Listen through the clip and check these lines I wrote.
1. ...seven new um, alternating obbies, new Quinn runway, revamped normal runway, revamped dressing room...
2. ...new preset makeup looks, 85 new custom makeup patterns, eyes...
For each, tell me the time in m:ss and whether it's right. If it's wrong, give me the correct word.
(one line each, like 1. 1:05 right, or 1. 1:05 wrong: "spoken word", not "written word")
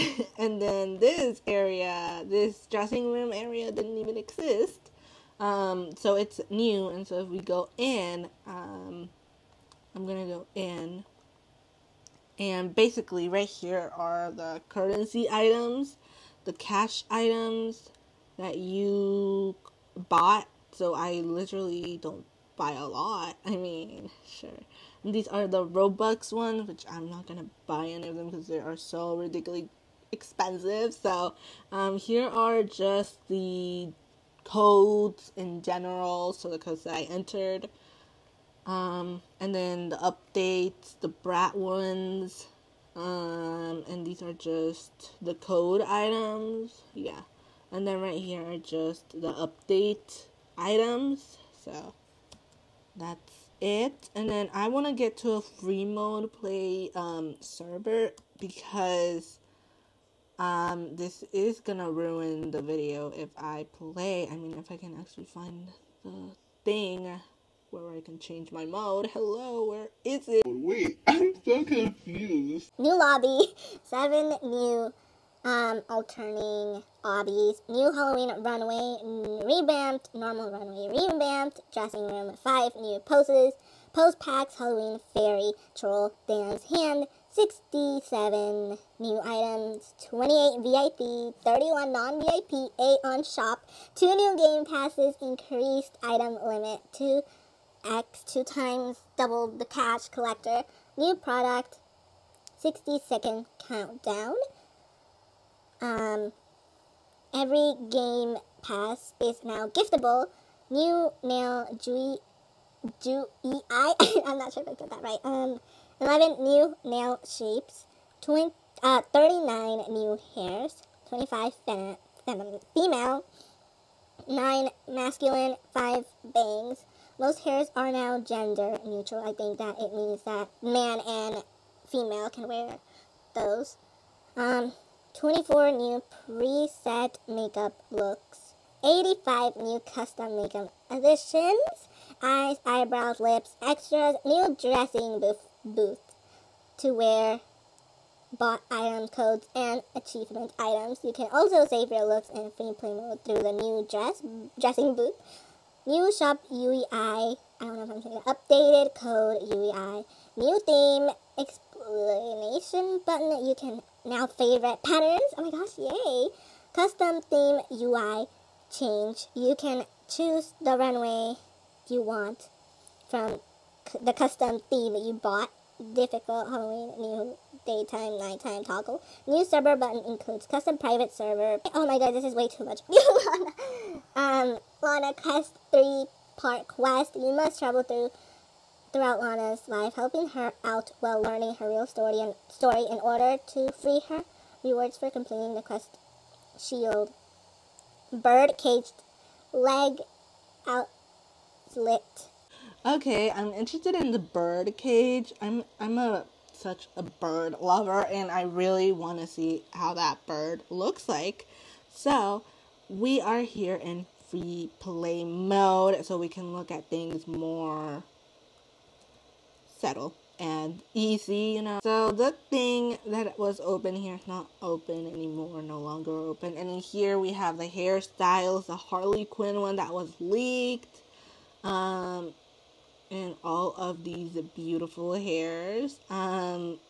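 1. 1:13 wrong: "Halloween", not "Quinn"
2. 2:15 wrong: "additions", not "patterns".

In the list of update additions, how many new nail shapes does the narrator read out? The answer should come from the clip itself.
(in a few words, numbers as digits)
11.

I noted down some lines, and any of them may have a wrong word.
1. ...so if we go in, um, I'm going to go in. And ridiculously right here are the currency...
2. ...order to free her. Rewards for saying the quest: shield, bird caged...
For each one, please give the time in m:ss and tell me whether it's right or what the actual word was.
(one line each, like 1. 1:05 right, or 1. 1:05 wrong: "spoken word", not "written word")
1. 0:07 wrong: "basically", not "ridiculously"
2. 3:13 wrong: "completing", not "saying".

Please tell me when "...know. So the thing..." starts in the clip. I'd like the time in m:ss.
3:41.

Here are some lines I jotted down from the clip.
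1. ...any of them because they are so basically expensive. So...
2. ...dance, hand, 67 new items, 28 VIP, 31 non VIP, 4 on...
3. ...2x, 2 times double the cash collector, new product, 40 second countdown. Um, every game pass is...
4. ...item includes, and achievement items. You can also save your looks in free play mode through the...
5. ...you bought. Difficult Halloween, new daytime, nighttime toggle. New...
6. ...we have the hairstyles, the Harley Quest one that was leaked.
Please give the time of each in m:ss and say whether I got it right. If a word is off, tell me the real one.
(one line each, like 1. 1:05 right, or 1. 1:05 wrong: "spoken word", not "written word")
1. 0:27 wrong: "ridiculously", not "basically"
2. 1:26 wrong: "8", not "4"
3. 1:36 wrong: "60", not "40"
4. 2:28 wrong: "codes", not "includes"
5. 2:55 right
6. 3:47 wrong: "Quinn", not "Quest".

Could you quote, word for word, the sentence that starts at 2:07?
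Most hairs are now gender neutral.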